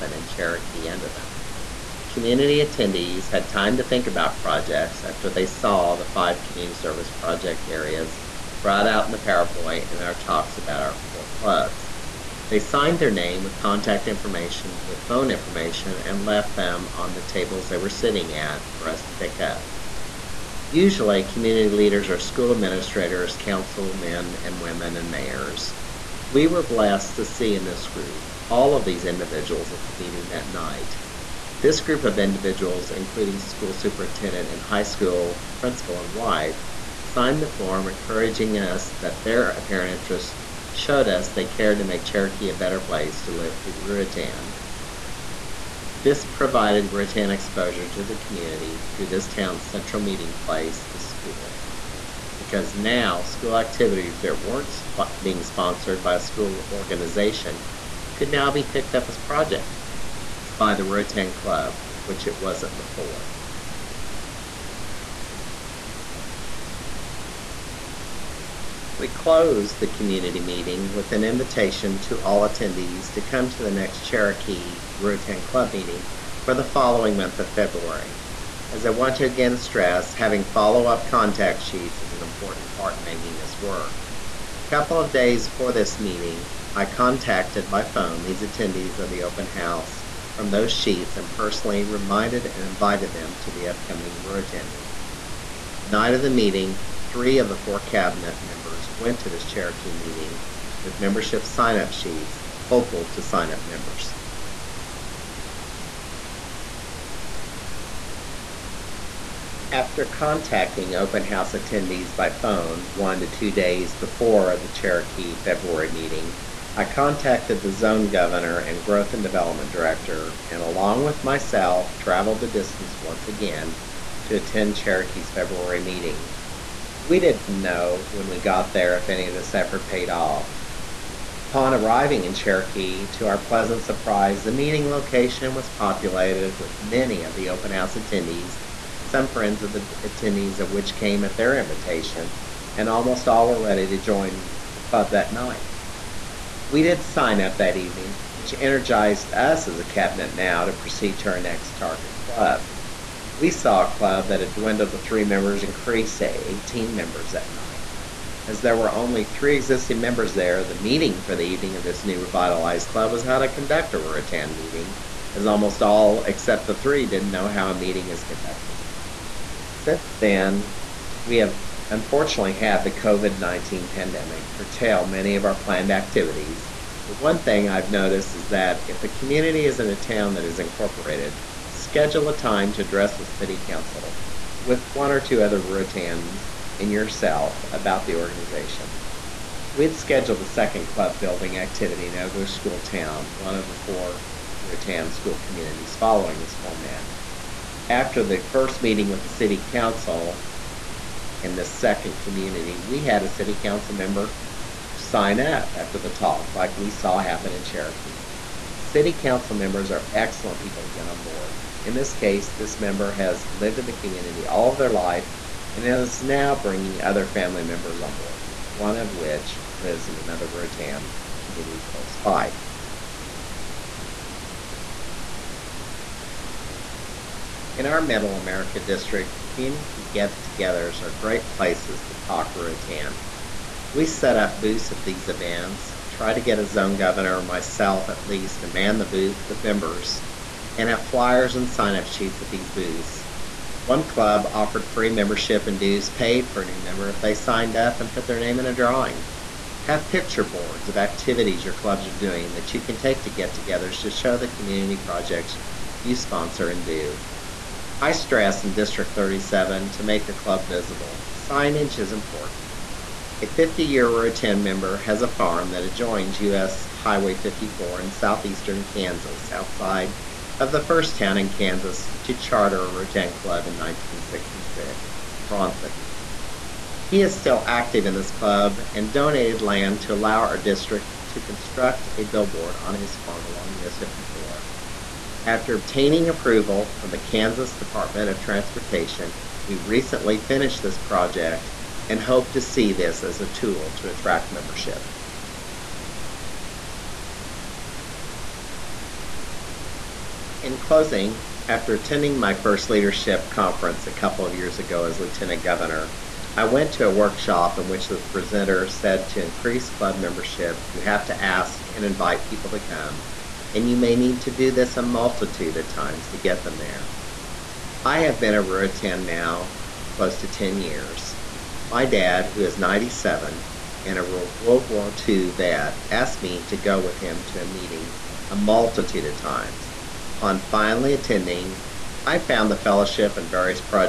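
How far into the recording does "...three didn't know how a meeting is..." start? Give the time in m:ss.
2:46.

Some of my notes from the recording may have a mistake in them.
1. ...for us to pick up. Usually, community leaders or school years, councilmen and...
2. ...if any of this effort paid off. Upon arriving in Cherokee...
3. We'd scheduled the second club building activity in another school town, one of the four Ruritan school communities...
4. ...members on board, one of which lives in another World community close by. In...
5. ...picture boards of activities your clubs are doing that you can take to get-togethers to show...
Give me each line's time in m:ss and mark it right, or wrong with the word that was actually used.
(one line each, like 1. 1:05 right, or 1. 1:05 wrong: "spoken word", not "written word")
1. 0:18 wrong: "administrators", not "years"
2. 2:08 right
3. 3:09 right
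4. 3:37 wrong: "Ruritan", not "World"
5. 4:10 right.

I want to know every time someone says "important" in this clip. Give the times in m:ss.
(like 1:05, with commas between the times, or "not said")
1:22, 4:22.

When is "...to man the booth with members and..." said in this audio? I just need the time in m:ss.
3:58.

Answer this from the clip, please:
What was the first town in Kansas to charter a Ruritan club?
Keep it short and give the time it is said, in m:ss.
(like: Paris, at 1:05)
Bronson, at 4:35.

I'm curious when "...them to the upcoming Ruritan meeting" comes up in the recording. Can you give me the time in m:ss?
1:33.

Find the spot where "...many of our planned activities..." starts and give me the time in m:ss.
2:55.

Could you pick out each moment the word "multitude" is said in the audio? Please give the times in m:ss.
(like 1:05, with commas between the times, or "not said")
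5:15, 5:28.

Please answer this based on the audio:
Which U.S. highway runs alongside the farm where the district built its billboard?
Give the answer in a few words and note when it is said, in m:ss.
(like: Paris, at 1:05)
US 54, at 4:26.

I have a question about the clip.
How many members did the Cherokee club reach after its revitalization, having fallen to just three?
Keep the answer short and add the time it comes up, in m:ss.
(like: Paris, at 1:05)
18, at 2:36.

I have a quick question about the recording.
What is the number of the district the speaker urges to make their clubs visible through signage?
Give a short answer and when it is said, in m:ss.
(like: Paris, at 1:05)
37, at 4:18.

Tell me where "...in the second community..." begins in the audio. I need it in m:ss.
3:21.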